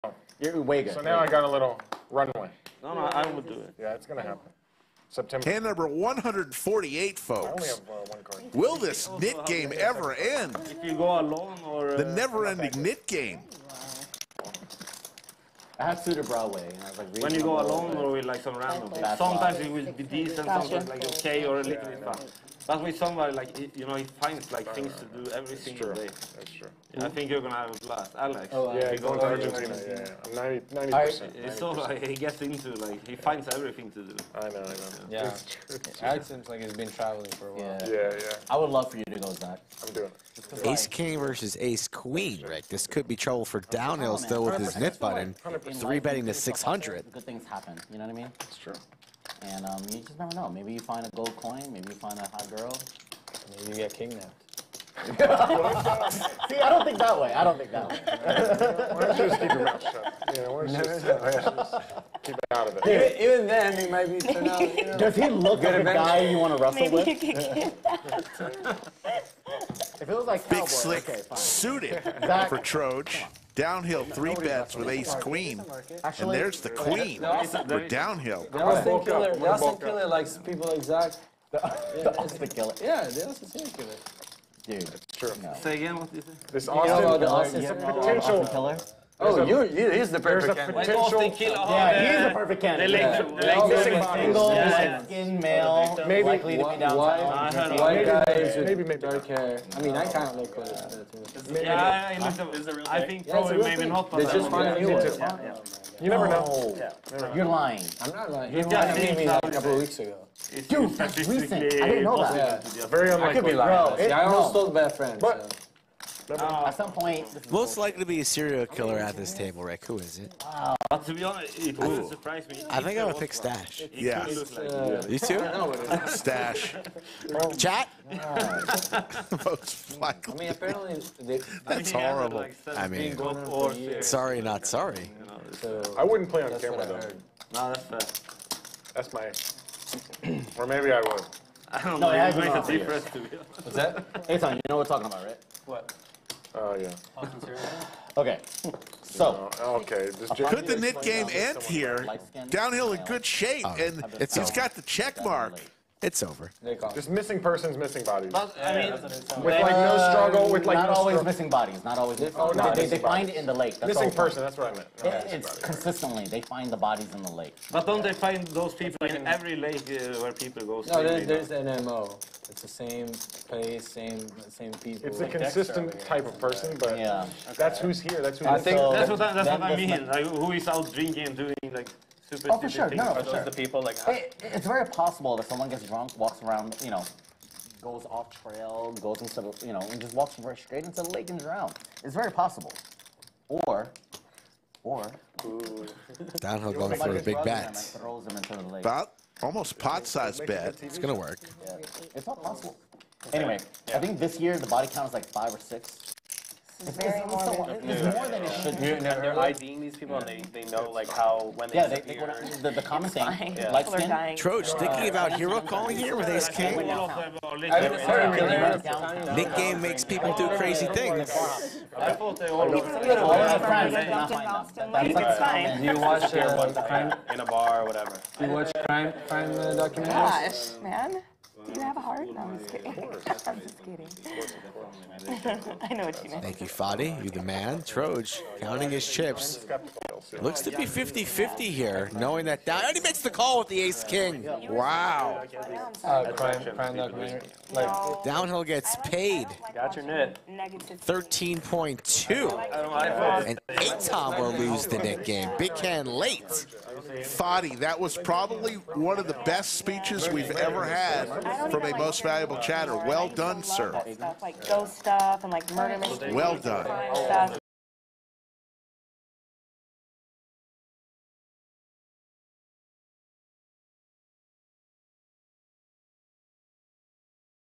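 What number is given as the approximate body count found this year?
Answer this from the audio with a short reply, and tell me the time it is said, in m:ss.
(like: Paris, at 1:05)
5 or 6, at 3:25.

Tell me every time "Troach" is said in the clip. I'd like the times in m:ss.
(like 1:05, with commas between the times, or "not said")
3:34.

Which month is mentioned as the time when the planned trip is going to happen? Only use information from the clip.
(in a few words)
September.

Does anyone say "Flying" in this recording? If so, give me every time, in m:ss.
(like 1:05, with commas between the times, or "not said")
3:33.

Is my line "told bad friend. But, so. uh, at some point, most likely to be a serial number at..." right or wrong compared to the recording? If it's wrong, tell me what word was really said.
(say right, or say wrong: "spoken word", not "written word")
wrong: "killer", not "number".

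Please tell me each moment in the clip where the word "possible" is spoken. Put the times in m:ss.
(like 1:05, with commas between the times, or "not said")
3:04, 3:12, 3:22.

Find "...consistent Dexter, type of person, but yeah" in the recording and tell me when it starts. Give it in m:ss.
2:55.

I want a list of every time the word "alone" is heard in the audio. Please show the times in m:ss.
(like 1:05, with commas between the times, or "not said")
0:11, 0:17.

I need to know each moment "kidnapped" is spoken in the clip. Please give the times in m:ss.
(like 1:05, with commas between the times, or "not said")
0:53.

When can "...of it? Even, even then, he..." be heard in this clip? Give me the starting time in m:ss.
1:02.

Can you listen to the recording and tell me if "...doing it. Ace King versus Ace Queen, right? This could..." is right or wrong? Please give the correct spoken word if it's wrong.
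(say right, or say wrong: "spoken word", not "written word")
right.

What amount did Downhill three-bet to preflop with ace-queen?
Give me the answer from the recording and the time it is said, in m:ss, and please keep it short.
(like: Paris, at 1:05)
600, at 0:46.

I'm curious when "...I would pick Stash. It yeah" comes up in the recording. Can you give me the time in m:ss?
2:02.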